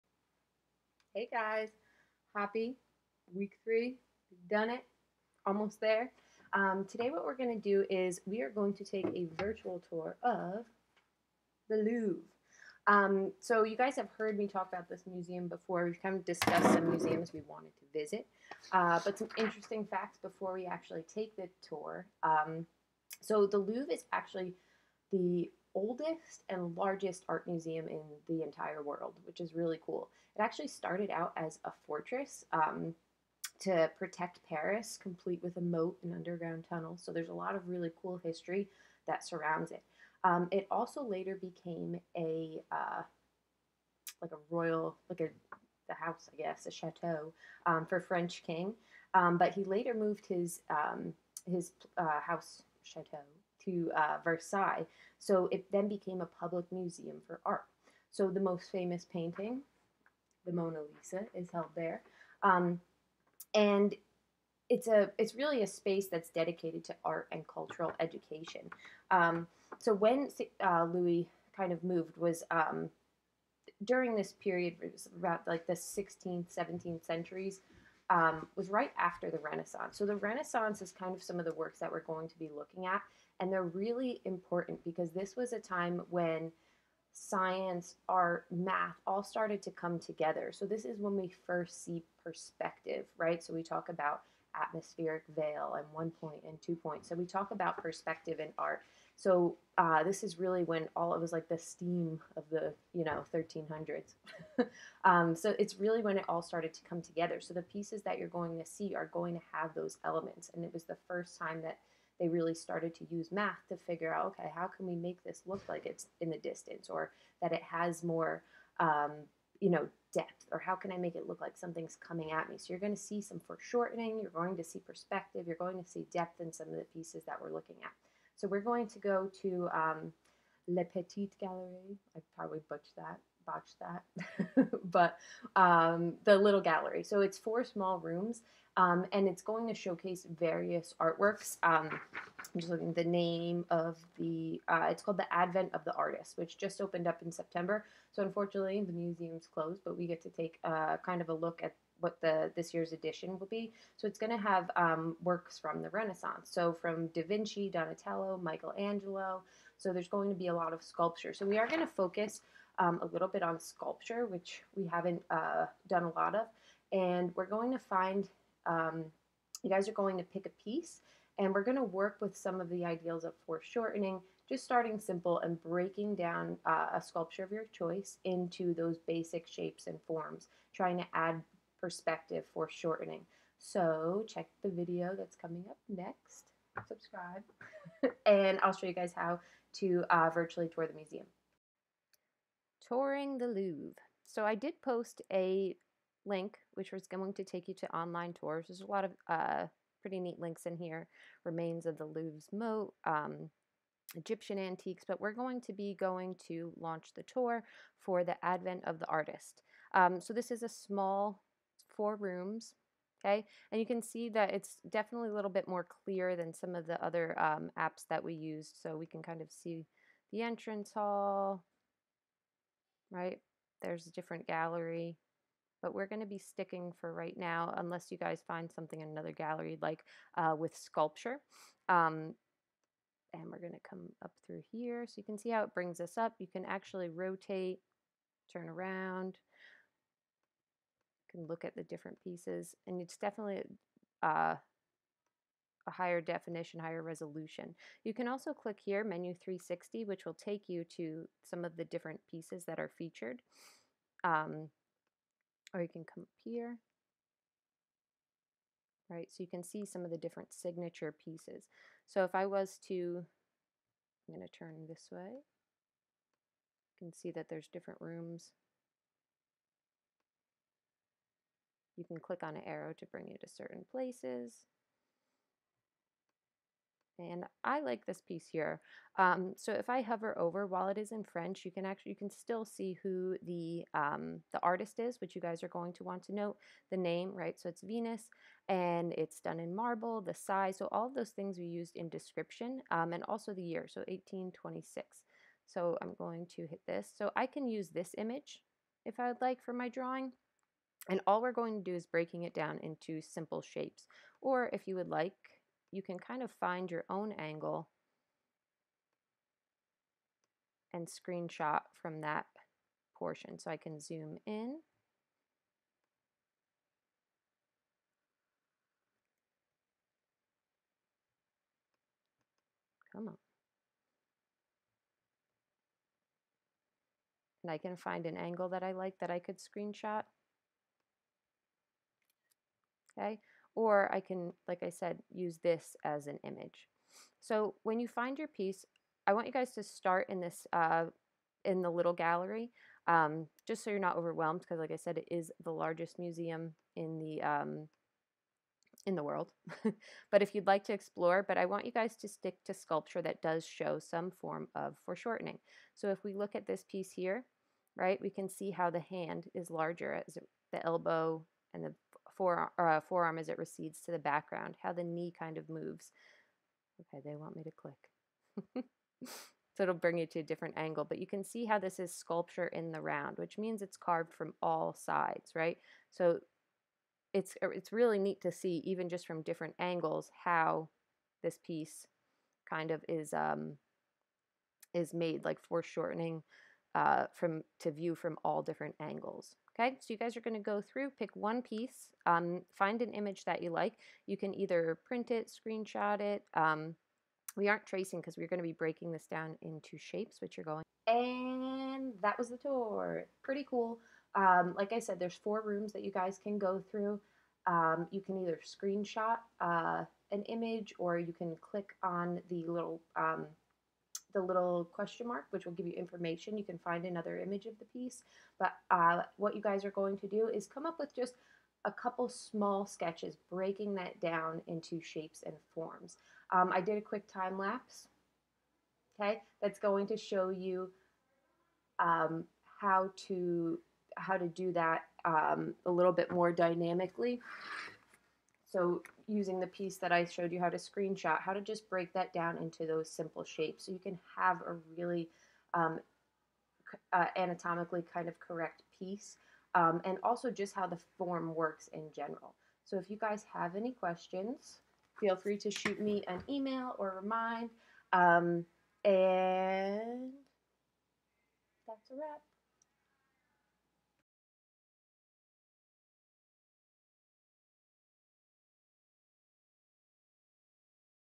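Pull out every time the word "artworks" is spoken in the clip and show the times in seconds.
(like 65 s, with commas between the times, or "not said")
140 s.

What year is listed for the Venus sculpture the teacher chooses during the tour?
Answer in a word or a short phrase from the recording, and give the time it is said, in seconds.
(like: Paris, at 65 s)
1826, at 294 s.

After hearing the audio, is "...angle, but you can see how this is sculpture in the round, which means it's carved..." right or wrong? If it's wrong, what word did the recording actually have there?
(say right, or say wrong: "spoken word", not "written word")
right.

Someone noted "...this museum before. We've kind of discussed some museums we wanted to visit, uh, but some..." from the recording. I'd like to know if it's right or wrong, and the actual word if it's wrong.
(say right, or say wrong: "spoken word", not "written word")
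right.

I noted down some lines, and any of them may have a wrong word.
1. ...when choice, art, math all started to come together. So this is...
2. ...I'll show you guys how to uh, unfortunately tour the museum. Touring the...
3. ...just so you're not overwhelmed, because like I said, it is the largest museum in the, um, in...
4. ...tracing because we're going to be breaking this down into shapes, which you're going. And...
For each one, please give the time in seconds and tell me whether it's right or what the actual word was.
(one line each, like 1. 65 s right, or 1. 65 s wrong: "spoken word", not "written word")
1. 86 s wrong: "science", not "choice"
2. 188 s wrong: "virtually", not "unfortunately"
3. 343 s right
4. 397 s right.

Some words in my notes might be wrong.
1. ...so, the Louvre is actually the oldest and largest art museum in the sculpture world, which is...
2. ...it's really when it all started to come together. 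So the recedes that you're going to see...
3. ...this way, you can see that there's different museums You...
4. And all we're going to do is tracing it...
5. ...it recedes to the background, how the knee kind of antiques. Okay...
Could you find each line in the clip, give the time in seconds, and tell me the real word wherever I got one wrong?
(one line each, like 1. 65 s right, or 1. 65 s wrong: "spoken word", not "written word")
1. 23 s wrong: "entire", not "sculpture"
2. 105 s wrong: "pieces", not "recedes"
3. 264 s wrong: "rooms", not "museums"
4. 301 s wrong: "breaking", not "tracing"
5. 363 s wrong: "moves", not "antiques".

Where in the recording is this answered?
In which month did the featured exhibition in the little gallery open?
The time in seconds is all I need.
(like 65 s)
147 s.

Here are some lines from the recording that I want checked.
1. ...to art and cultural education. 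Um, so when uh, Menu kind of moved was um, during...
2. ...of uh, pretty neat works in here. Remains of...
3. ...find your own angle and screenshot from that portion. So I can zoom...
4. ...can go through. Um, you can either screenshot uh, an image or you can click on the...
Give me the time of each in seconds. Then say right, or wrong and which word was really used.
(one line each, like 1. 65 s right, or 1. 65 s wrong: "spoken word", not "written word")
1. 66 s wrong: "Louis", not "Menu"
2. 199 s wrong: "links", not "works"
3. 306 s right
4. 406 s right.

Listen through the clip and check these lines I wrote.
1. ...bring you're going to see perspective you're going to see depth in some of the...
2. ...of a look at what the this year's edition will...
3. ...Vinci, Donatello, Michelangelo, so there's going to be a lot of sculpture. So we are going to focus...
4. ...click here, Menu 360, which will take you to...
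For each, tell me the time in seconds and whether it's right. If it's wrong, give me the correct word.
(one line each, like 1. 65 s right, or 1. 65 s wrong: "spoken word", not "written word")
1. 123 s wrong: "foreshortening", not "bring"
2. 151 s right
3. 157 s right
4. 248 s right.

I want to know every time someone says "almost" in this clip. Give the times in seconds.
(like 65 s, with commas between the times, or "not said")
5 s.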